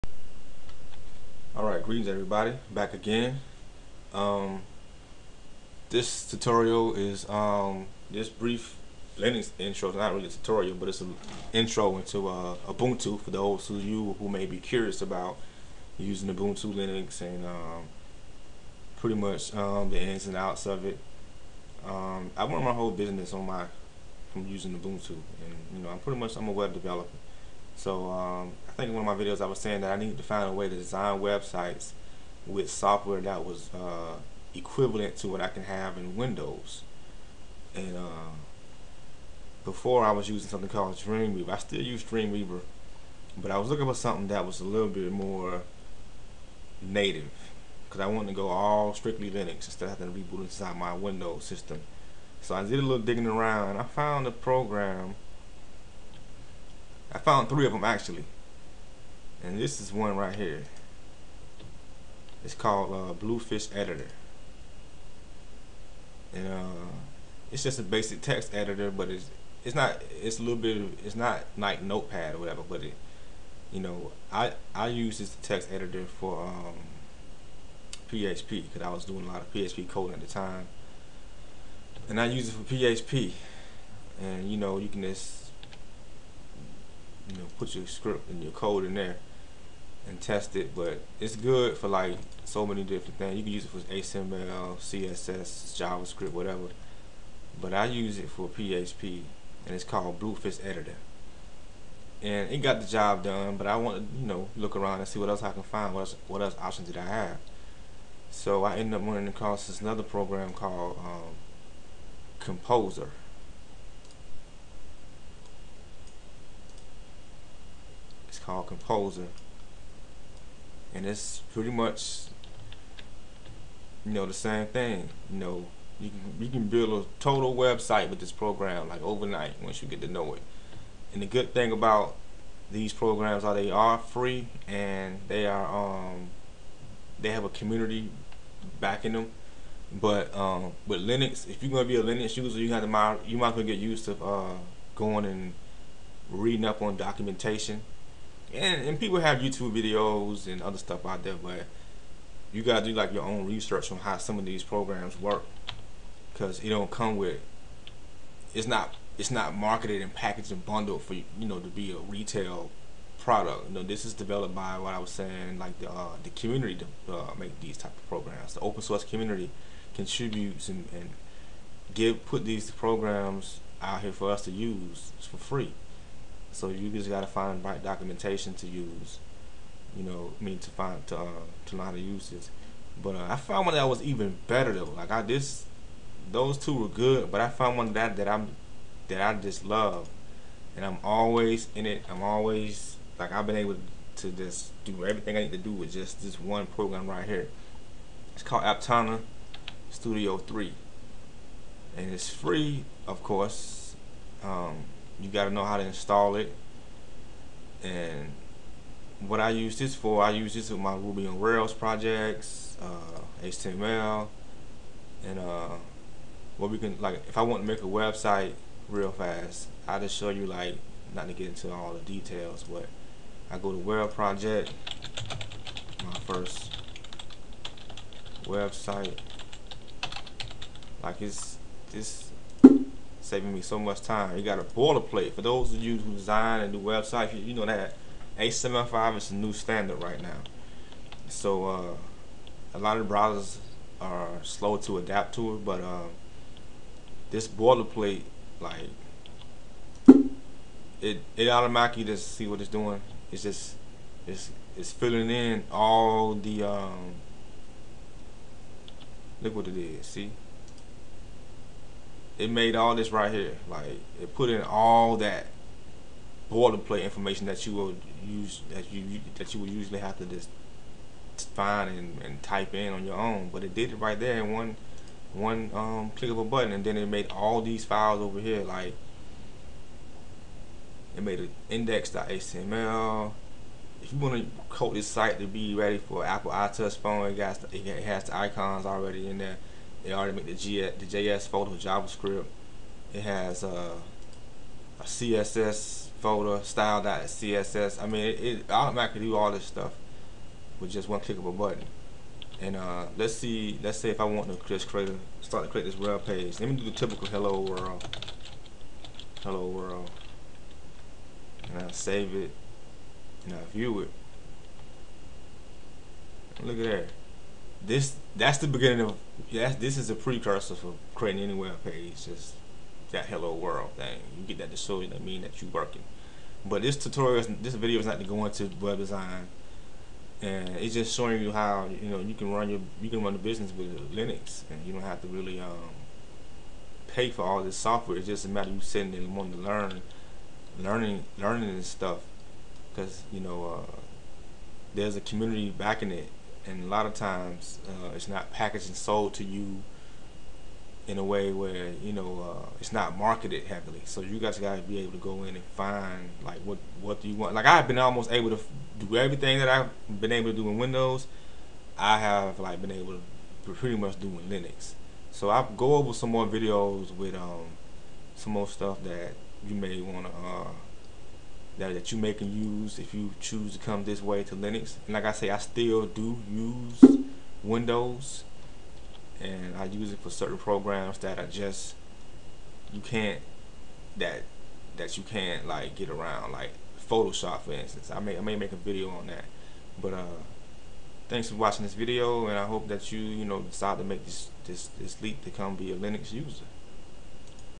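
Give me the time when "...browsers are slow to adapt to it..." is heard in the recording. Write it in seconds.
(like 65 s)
243 s.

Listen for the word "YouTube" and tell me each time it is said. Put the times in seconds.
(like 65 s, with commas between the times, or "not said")
149 s.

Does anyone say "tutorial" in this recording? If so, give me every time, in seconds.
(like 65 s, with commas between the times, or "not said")
6 s, 10 s, 326 s.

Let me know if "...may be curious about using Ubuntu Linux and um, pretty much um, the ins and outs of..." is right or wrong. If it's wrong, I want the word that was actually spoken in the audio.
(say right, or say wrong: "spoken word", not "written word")
right.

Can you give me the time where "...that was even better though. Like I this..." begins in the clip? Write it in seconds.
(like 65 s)
183 s.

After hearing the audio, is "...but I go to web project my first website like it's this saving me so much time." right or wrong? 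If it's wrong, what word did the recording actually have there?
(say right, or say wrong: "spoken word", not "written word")
right.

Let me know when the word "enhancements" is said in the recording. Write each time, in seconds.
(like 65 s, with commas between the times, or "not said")
not said.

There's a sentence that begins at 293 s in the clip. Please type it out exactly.
It has uh, a CSS folder, style.css.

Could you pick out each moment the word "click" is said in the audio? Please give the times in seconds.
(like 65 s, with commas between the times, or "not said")
276 s, 301 s.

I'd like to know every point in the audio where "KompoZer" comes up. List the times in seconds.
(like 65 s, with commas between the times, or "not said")
112 s, 118 s.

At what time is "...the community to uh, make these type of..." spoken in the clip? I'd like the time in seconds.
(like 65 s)
166 s.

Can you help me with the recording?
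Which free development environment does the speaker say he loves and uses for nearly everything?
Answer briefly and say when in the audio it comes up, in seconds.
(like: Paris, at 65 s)
Aptana Studio 3, at 198 s.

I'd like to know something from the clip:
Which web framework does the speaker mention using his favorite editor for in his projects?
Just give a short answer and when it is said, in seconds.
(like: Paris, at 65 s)
Ruby on Rails, at 210 s.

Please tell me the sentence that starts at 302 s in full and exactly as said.
And uh, let's see, let's say if I want to just create a, start to create this web page.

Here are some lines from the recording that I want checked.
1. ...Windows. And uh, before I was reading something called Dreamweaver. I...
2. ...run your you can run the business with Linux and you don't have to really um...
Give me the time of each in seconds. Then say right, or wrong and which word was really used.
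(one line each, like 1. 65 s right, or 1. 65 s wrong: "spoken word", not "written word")
1. 36 s wrong: "using", not "reading"
2. 332 s right.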